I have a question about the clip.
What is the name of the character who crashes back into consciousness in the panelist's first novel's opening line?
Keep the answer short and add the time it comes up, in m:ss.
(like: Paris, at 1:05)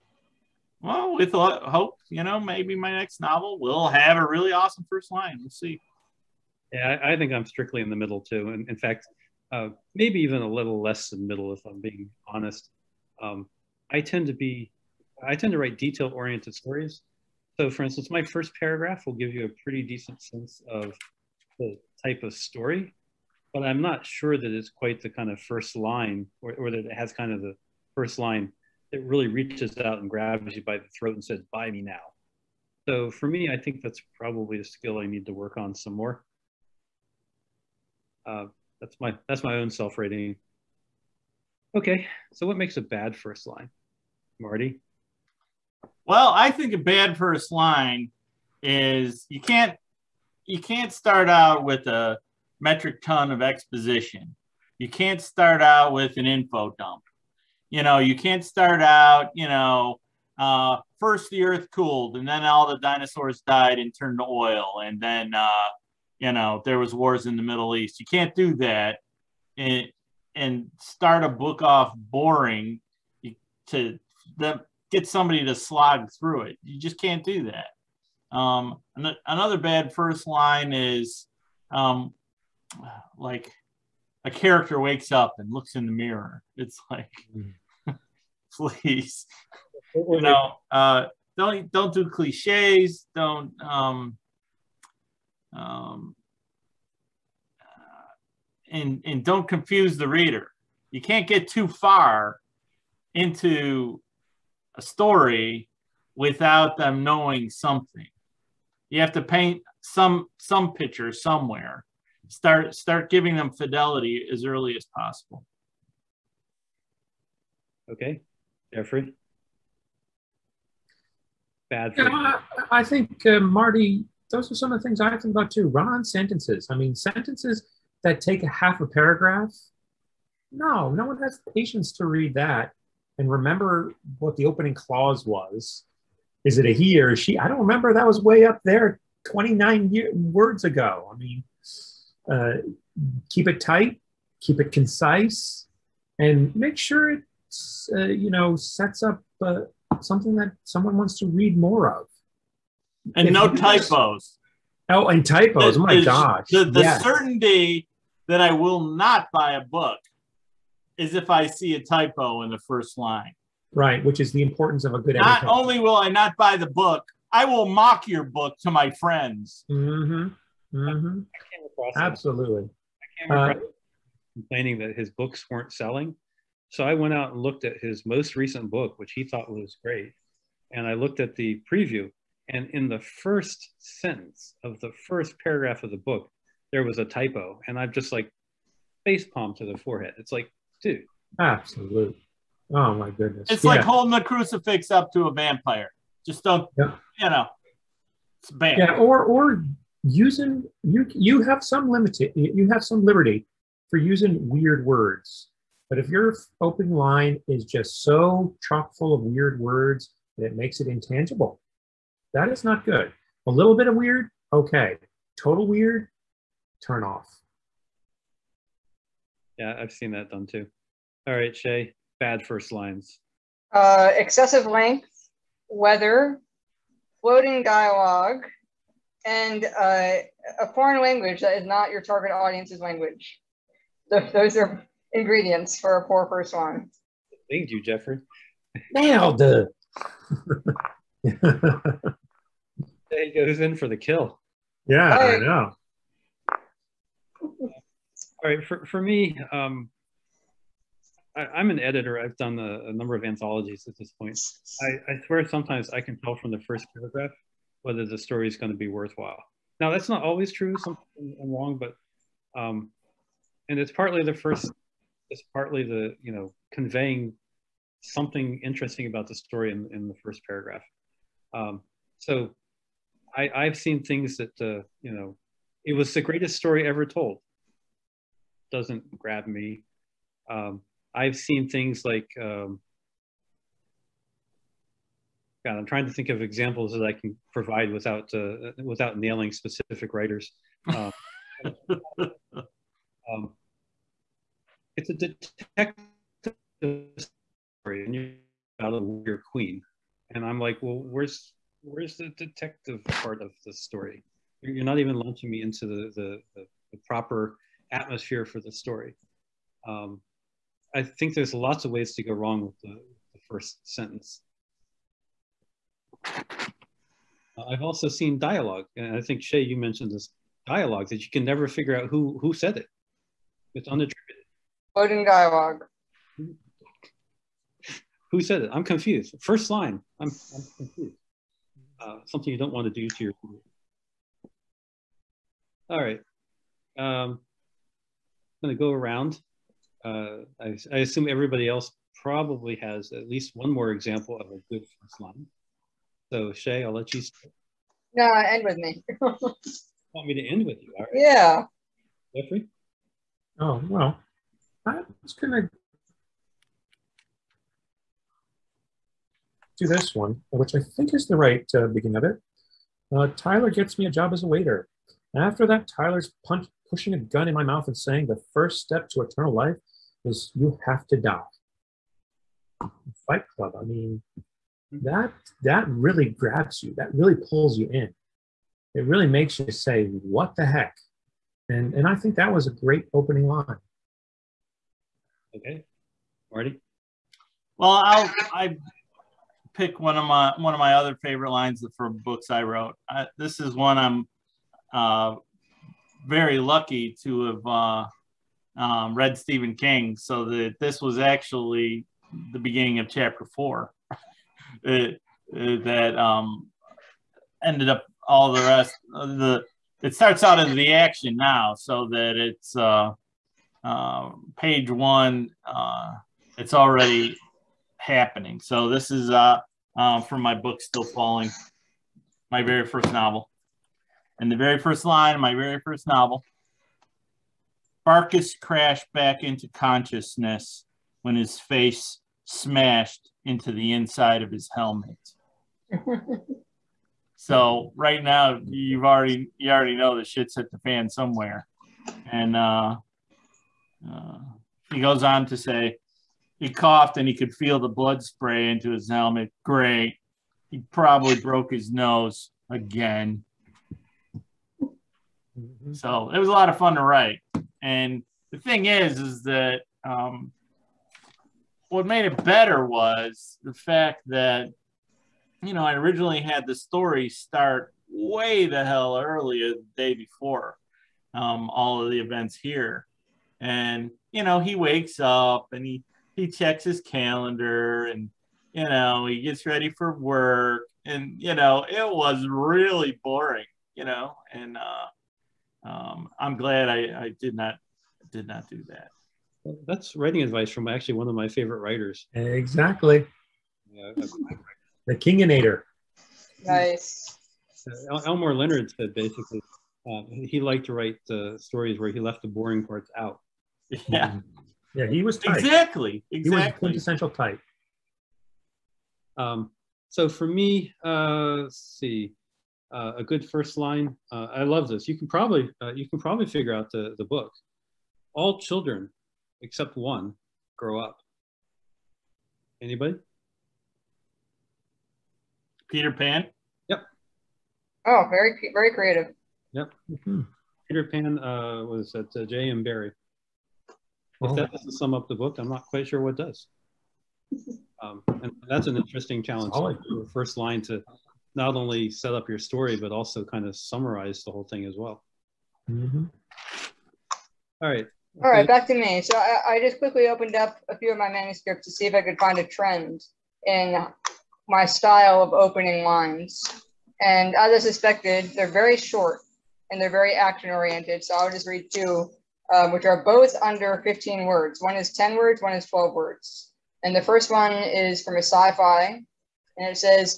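Barkus, at 7:08.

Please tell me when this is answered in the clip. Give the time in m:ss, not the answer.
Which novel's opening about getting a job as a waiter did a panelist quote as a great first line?
6:13.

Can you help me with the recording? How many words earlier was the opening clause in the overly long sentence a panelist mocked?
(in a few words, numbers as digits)
29.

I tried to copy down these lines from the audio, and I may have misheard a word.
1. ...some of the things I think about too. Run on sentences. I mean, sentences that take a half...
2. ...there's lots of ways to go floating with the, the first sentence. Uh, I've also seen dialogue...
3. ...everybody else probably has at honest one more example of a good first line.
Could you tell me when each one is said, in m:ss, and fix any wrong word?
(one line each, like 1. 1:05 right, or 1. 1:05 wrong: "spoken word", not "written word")
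1. 2:04 right
2. 5:11 wrong: "wrong", not "floating"
3. 5:41 wrong: "least", not "honest".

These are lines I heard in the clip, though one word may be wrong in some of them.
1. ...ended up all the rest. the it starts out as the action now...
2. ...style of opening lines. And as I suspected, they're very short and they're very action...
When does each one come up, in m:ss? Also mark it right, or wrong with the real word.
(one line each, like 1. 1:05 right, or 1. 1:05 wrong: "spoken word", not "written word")
1. 6:47 right
2. 9:14 right.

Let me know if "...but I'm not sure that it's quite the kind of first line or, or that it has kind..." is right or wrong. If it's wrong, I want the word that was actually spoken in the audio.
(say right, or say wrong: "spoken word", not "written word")
right.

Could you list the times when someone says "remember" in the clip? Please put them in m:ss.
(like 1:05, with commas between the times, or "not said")
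2:13, 2:17.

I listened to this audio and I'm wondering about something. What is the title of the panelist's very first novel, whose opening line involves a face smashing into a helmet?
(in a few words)
Still Falling.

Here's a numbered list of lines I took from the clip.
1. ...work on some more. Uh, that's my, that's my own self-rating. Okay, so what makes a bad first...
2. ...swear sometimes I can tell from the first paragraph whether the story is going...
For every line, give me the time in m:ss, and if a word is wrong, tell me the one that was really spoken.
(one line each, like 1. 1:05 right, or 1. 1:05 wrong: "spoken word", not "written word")
1. 0:35 right
2. 4:15 right.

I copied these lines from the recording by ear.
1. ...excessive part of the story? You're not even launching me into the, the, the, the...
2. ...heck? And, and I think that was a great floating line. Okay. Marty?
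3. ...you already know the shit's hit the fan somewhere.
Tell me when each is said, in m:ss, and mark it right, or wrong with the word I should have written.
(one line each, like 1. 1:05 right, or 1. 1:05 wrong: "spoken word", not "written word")
1. 5:02 wrong: "detective", not "excessive"
2. 6:20 wrong: "opening", not "floating"
3. 7:19 right.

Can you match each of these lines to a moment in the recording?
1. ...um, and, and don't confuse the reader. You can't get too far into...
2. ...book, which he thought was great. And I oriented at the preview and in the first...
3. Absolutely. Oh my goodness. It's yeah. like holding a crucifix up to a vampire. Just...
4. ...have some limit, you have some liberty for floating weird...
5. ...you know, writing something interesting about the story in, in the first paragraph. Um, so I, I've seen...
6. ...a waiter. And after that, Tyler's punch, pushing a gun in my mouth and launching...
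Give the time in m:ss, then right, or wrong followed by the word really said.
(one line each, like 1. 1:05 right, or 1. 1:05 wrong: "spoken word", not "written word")
1. 1:35 right
2. 2:58 wrong: "looked", not "oriented"
3. 3:11 right
4. 3:21 wrong: "using", not "floating"
5. 4:26 wrong: "conveying", not "writing"
6. 6:04 wrong: "saying", not "launching".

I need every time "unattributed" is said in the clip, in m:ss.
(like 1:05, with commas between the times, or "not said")
5:23.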